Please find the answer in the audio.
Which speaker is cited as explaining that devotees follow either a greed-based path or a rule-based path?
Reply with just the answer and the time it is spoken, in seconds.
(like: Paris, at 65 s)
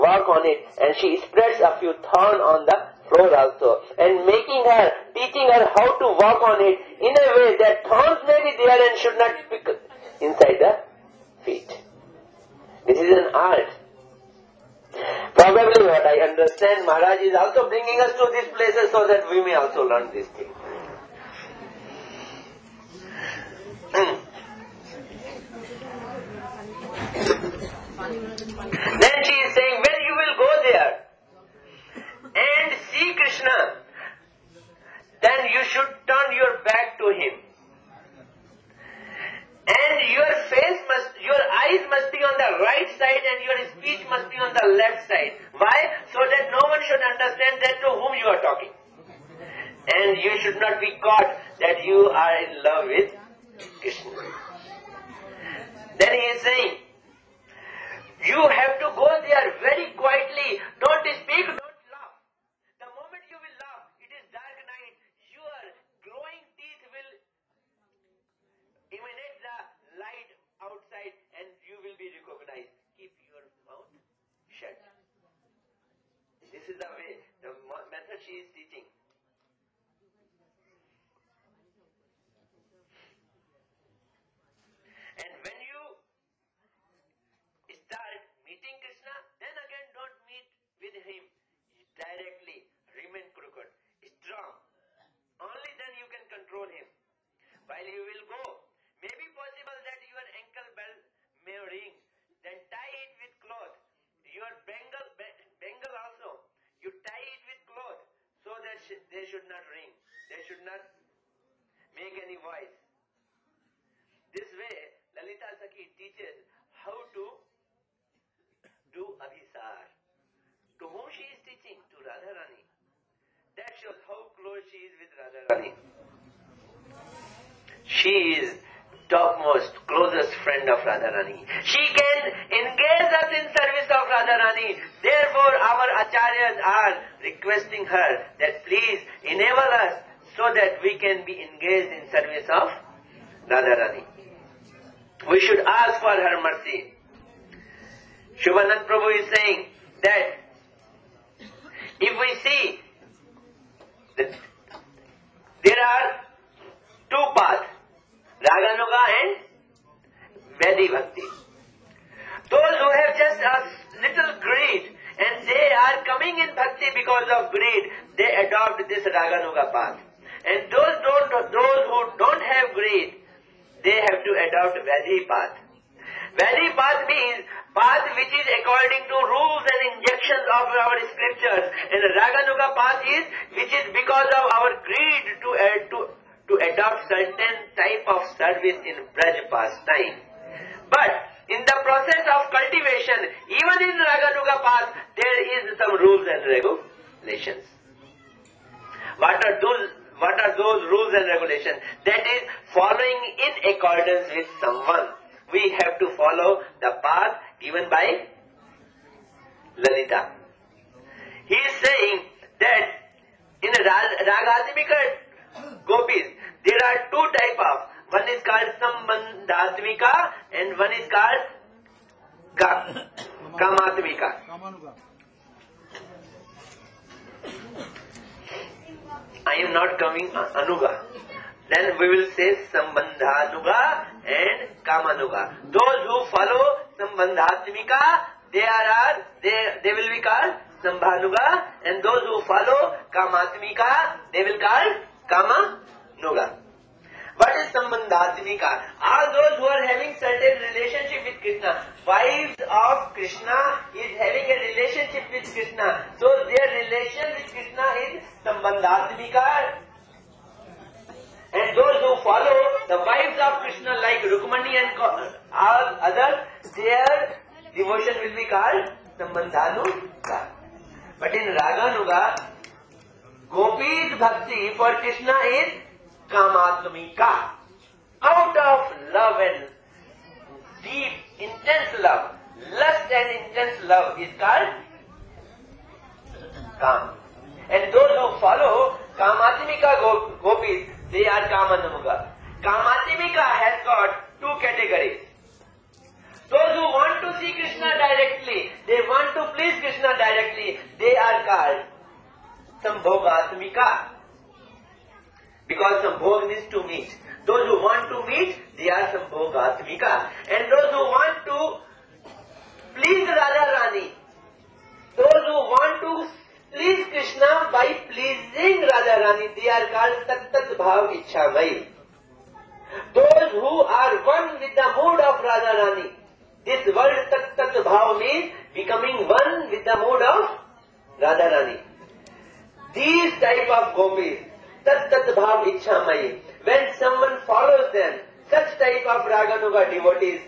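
Shivanand Prabhu, at 148 s.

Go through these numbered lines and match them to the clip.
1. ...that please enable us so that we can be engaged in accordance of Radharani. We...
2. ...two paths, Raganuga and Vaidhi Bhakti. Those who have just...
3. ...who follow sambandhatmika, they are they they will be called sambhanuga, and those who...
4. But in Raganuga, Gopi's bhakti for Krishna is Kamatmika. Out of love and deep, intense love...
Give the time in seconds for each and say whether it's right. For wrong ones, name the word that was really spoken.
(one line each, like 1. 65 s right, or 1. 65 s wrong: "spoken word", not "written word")
1. 138 s wrong: "service", not "accordance"
2. 157 s right
3. 236 s right
4. 271 s right.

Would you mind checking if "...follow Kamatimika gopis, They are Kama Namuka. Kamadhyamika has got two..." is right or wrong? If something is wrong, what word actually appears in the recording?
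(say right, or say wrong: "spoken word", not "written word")
right.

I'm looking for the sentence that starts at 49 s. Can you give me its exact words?
And you should not be caught that you are in love with Krishna.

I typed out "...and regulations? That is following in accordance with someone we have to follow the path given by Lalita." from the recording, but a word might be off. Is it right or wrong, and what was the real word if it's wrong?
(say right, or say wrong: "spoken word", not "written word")
right.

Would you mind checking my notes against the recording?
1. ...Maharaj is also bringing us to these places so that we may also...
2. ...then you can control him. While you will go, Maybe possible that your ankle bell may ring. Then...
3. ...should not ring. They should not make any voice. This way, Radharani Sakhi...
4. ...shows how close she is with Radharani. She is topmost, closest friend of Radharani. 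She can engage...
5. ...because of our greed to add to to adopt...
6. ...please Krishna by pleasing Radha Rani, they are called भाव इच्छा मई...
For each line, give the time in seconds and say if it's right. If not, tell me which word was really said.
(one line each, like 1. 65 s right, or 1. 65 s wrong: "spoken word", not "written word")
1. 16 s right
2. 95 s right
3. 109 s wrong: "Lalita", not "Radharani"
4. 123 s right
5. 183 s right
6. 316 s right.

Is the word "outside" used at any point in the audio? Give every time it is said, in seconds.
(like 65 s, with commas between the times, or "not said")
70 s.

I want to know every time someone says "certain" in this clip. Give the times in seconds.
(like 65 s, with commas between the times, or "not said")
187 s, 250 s.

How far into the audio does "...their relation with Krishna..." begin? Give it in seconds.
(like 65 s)
256 s.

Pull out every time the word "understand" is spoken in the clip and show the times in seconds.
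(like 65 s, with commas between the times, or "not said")
16 s, 46 s.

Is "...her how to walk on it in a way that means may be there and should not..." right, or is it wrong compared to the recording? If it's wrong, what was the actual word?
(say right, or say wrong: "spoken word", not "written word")
wrong: "thorns", not "means".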